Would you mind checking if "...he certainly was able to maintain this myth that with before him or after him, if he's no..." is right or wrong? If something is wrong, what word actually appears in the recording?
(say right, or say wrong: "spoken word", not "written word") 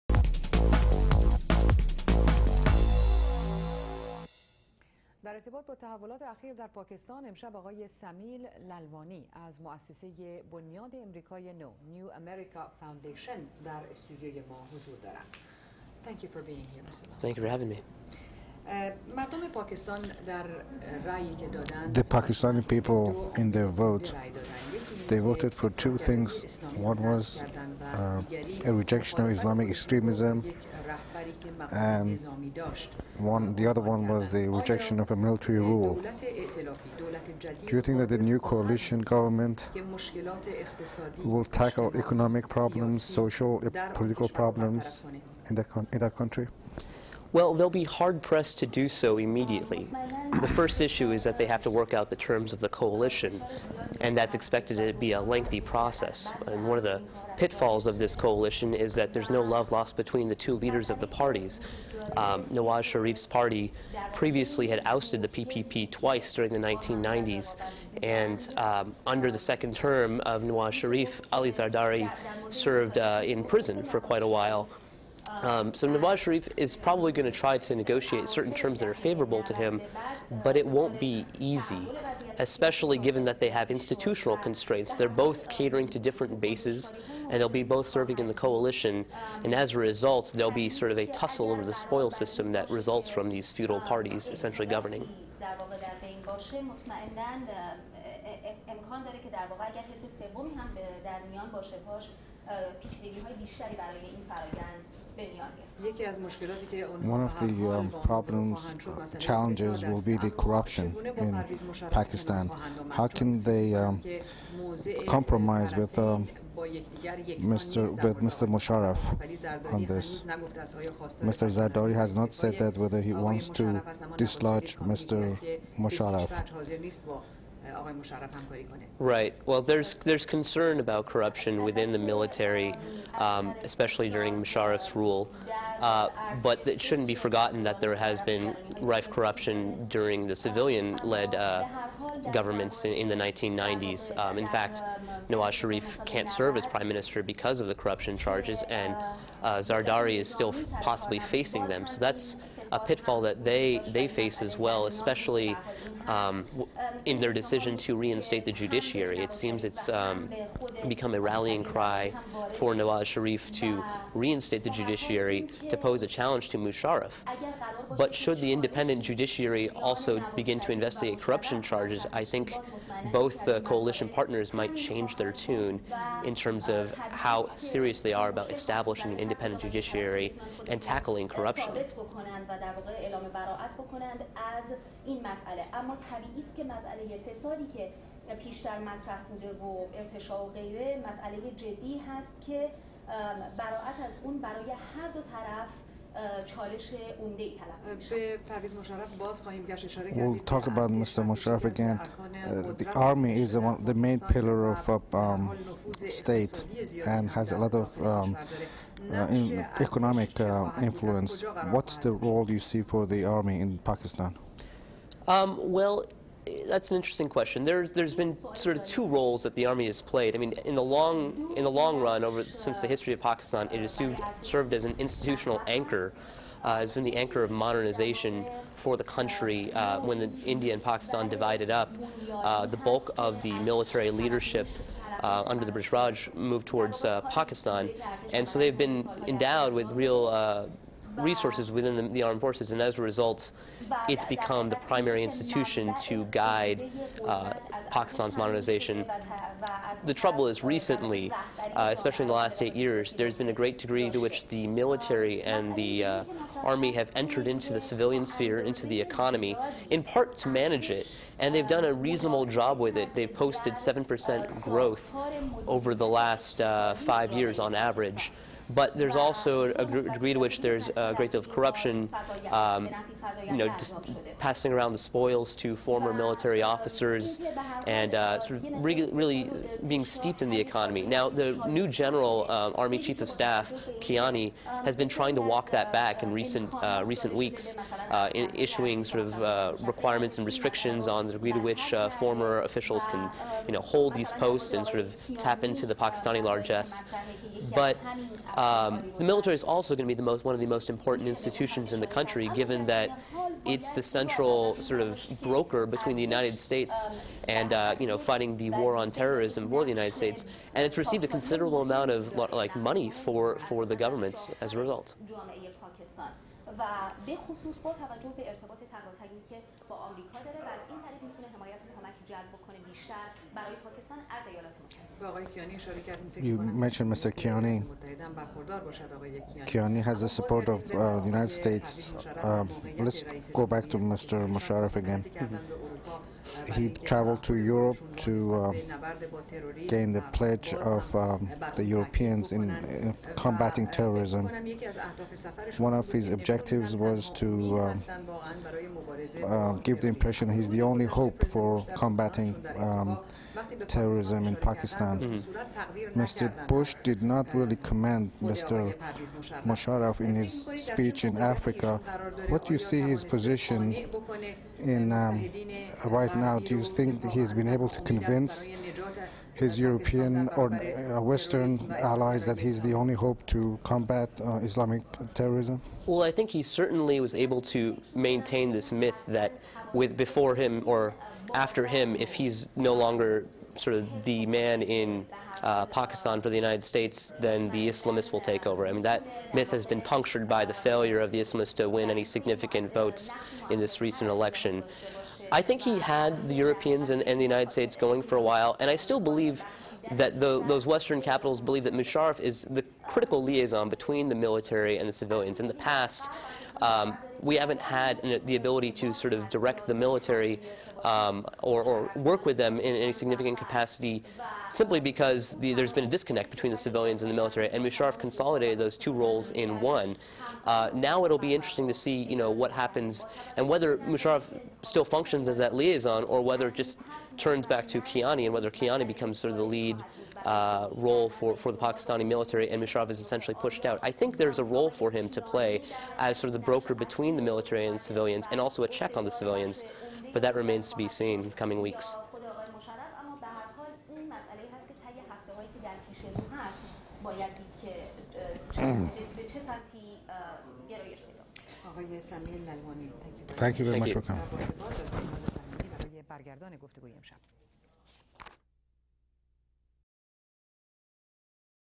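right.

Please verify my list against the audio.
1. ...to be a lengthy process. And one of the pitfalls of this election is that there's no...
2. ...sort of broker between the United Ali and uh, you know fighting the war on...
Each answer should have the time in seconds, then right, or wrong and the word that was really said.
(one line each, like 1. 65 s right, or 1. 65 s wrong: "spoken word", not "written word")
1. 54 s wrong: "coalition", not "election"
2. 304 s wrong: "States", not "Ali".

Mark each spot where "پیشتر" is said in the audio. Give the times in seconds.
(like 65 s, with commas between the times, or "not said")
188 s.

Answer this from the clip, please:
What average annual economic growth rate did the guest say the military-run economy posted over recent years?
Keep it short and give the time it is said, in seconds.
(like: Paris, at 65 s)
7%, at 263 s.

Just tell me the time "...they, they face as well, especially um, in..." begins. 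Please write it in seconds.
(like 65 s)
153 s.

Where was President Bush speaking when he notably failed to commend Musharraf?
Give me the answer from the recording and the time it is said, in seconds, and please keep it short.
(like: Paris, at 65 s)
Africa, at 361 s.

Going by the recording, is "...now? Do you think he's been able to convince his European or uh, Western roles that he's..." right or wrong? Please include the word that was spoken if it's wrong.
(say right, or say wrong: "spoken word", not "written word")
wrong: "allies", not "roles".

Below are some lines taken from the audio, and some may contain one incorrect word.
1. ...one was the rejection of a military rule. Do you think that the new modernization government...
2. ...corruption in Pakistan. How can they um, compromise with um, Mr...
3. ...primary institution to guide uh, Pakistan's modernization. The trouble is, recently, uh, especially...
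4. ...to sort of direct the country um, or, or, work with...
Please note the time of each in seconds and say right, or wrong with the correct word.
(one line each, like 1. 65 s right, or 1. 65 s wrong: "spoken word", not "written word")
1. 33 s wrong: "coalition", not "modernization"
2. 110 s right
3. 244 s right
4. 408 s wrong: "military", not "country".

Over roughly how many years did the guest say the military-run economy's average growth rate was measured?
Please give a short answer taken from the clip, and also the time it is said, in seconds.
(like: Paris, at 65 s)
five years, at 266 s.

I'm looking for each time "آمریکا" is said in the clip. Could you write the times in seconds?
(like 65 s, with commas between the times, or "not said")
319 s.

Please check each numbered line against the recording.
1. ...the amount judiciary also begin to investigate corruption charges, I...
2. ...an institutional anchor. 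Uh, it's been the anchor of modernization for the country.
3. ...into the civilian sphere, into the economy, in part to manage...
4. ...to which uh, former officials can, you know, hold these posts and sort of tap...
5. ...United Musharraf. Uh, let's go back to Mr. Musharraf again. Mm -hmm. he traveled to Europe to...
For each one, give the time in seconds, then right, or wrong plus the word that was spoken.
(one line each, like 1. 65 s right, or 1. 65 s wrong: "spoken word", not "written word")
1. 168 s wrong: "independent", not "amount"
2. 224 s right
3. 257 s right
4. 291 s right
5. 331 s wrong: "States", not "Musharraf".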